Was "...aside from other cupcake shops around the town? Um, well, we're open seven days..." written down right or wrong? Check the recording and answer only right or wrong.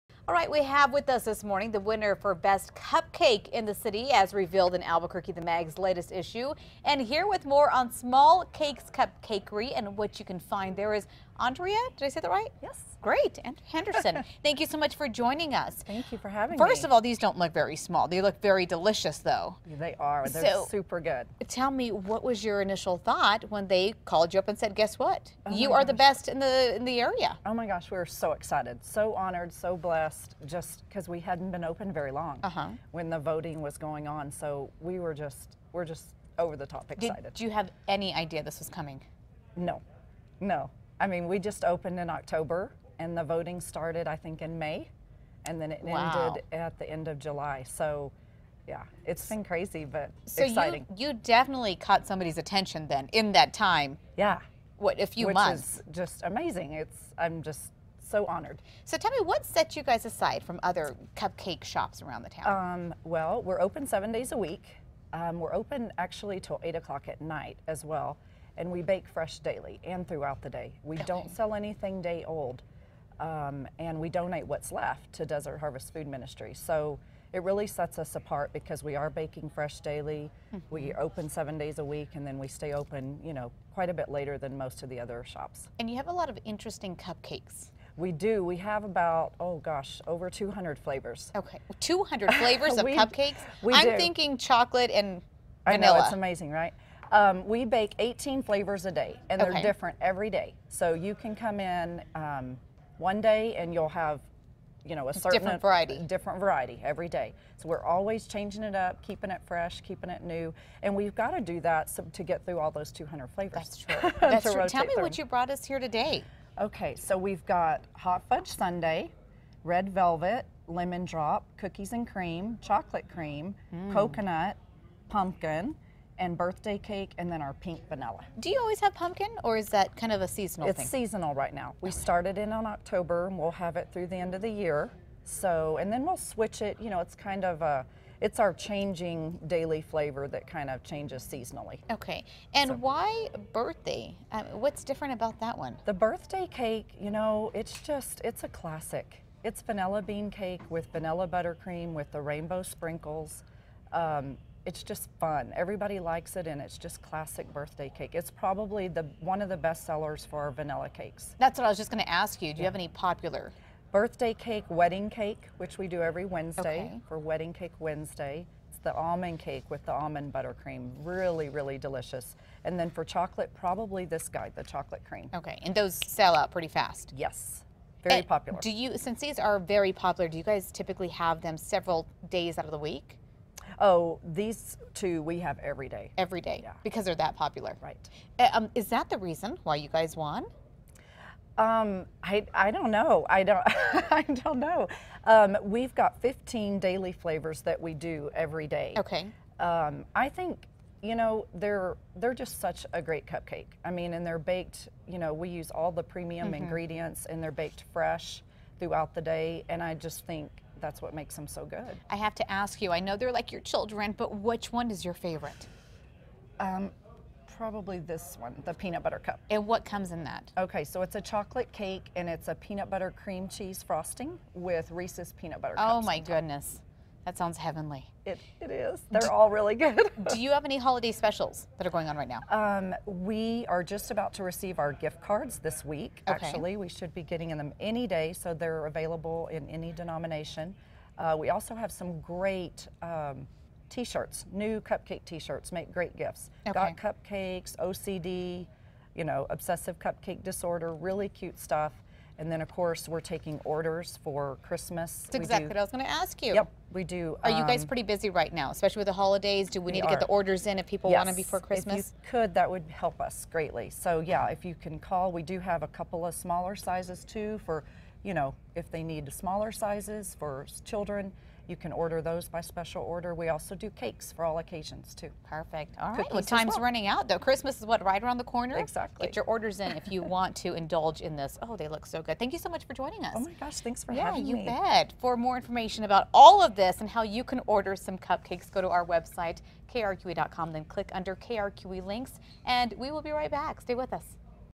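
right.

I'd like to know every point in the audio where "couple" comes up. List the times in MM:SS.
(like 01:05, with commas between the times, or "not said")
04:25.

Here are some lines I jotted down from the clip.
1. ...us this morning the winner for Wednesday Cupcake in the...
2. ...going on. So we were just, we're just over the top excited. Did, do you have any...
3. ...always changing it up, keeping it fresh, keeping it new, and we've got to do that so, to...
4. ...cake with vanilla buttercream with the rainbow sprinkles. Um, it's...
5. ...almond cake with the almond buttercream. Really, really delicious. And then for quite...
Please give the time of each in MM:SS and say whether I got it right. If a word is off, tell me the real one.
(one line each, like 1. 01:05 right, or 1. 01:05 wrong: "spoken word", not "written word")
1. 00:01 wrong: "Best", not "Wednesday"
2. 00:33 right
3. 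01:47 right
4. 02:30 right
5. 02:48 wrong: "chocolate", not "quite".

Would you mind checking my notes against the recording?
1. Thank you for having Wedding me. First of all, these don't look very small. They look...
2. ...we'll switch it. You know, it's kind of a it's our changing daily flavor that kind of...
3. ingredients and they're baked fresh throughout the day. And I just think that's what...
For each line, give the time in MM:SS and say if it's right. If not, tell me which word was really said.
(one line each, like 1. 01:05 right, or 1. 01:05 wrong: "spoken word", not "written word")
1. 00:15 wrong: "First", not "Wedding"
2. 02:16 right
3. 03:26 right.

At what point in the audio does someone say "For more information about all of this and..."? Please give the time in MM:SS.
04:45.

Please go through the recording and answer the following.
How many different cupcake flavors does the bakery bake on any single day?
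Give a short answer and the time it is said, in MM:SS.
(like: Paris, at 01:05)
18, at 01:37.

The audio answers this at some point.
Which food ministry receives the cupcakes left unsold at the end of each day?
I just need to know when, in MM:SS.
01:15.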